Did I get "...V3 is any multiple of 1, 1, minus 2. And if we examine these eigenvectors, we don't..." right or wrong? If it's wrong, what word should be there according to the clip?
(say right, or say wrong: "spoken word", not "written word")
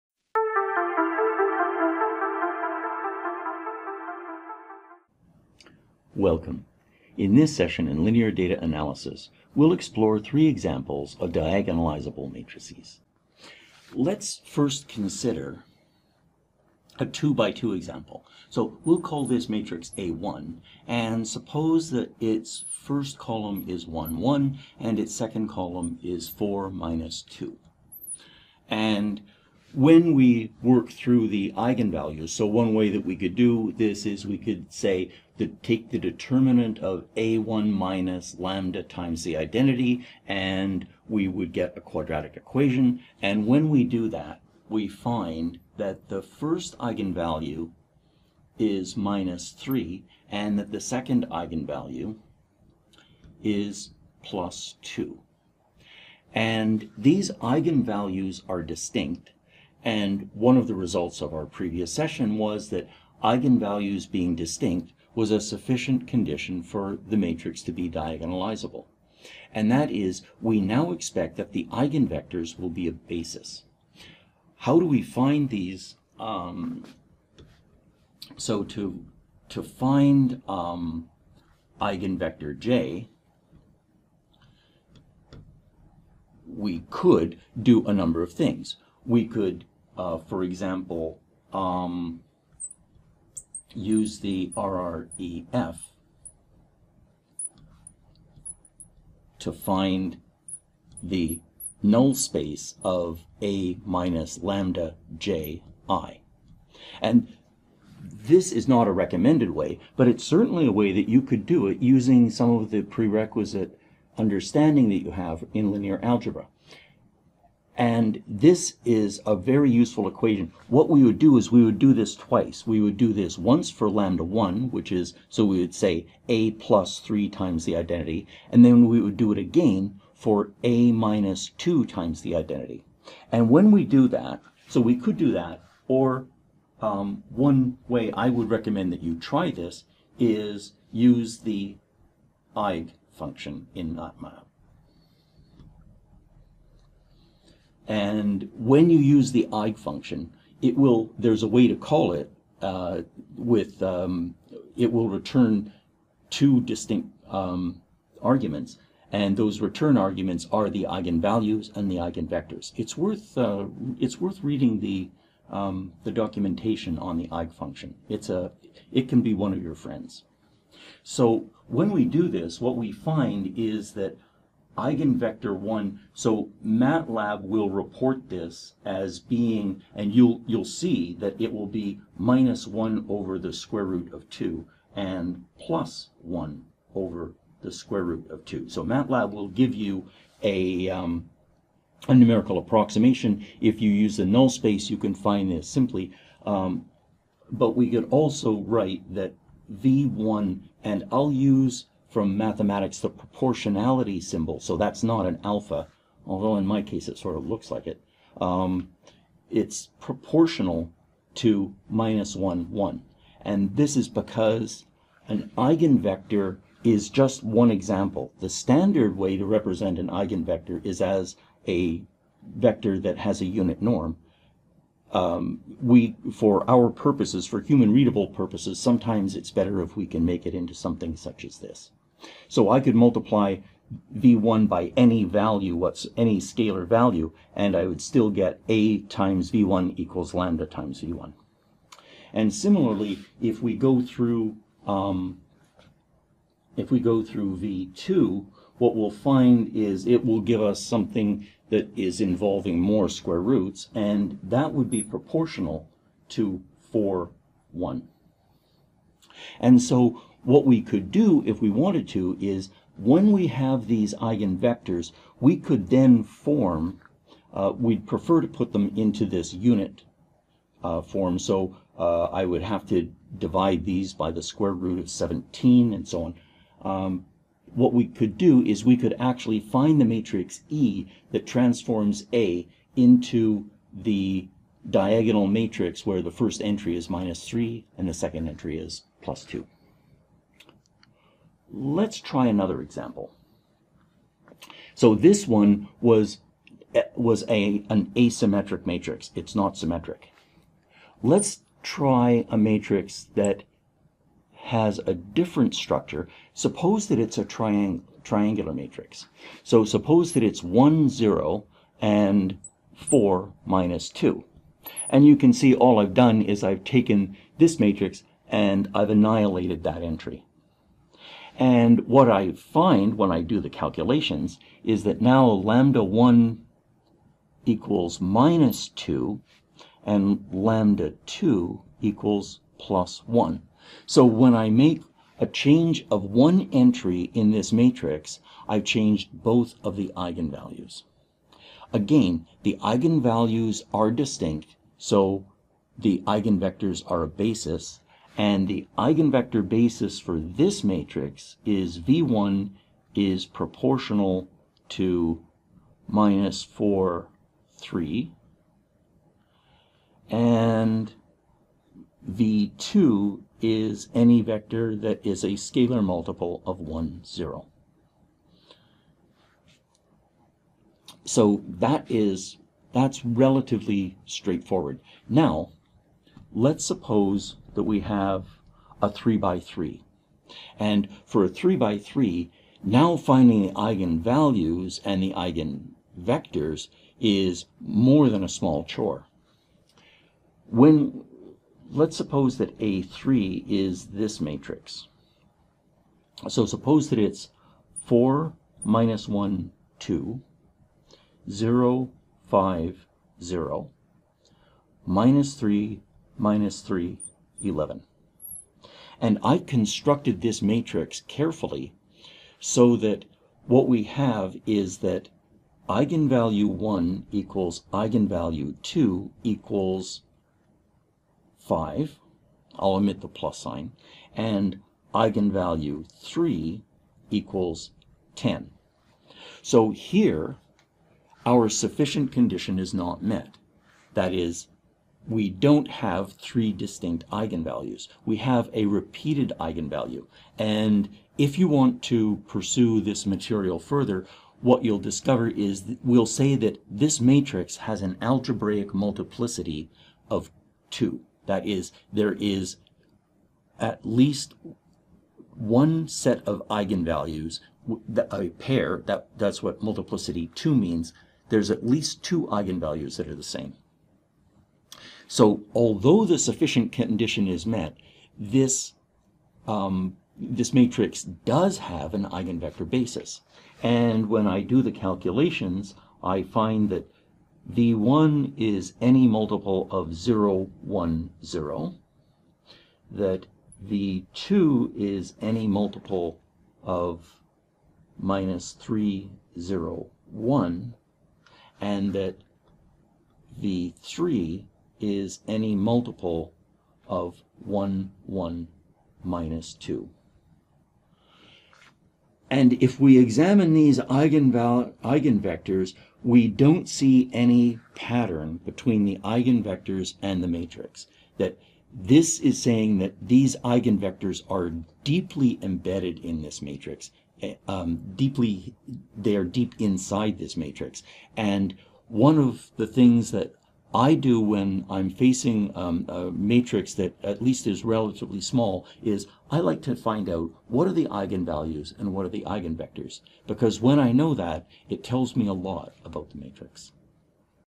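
right.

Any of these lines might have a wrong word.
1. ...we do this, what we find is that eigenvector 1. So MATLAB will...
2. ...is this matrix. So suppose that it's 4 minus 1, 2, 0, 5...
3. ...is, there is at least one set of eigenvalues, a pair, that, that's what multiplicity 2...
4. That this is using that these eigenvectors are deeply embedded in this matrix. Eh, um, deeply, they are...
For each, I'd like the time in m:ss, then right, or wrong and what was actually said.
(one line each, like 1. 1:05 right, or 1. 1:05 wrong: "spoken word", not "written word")
1. 2:51 right
2. 6:33 right
3. 7:31 right
4. 8:31 wrong: "saying", not "using".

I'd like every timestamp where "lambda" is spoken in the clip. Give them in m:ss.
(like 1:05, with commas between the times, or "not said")
0:38, 1:44, 2:03, 4:00, 5:25, 5:30.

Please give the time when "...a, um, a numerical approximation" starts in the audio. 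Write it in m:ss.
3:10.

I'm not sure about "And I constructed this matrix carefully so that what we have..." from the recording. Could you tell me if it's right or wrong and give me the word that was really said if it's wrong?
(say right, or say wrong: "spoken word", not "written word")
right.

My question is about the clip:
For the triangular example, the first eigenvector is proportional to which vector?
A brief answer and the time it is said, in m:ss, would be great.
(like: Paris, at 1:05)
(-4, 3), at 5:56.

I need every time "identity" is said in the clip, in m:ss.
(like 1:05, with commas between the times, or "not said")
0:39, 2:07, 2:12.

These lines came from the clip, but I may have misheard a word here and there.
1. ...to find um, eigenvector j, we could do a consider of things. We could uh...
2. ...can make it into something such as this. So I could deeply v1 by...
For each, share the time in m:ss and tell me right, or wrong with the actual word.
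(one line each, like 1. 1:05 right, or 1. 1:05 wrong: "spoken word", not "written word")
1. 1:19 wrong: "number", not "consider"
2. 3:50 wrong: "multiply", not "deeply".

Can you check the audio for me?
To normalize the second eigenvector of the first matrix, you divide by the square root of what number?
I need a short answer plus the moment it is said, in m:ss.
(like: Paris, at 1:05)
17, at 4:35.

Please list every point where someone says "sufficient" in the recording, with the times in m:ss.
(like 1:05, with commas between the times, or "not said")
1:05, 7:11, 7:46.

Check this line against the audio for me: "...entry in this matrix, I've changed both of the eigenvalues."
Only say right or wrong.
right.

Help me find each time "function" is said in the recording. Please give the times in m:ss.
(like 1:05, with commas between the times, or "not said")
2:23, 2:29, 2:47.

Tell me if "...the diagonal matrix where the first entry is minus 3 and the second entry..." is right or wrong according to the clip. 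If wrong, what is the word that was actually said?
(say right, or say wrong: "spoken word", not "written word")
right.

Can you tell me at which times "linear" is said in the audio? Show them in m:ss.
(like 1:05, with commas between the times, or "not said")
0:08, 1:55.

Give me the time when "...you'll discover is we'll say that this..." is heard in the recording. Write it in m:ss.
7:24.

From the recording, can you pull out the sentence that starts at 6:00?
And V2 is any vector that is a scalar multiple of 1, 0.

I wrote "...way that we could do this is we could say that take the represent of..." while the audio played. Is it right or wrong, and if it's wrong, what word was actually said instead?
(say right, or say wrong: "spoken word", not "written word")
wrong: "determinant", not "represent".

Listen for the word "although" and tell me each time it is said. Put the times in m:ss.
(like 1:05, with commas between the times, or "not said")
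3:26, 7:45.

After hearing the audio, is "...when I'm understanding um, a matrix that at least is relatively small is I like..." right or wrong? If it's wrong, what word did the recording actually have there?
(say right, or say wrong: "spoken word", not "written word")
wrong: "facing", not "understanding".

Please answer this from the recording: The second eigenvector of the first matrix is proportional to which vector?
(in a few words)
(4, 1).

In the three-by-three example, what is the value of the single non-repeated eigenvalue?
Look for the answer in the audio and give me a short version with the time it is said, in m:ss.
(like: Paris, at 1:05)
10, at 7:08.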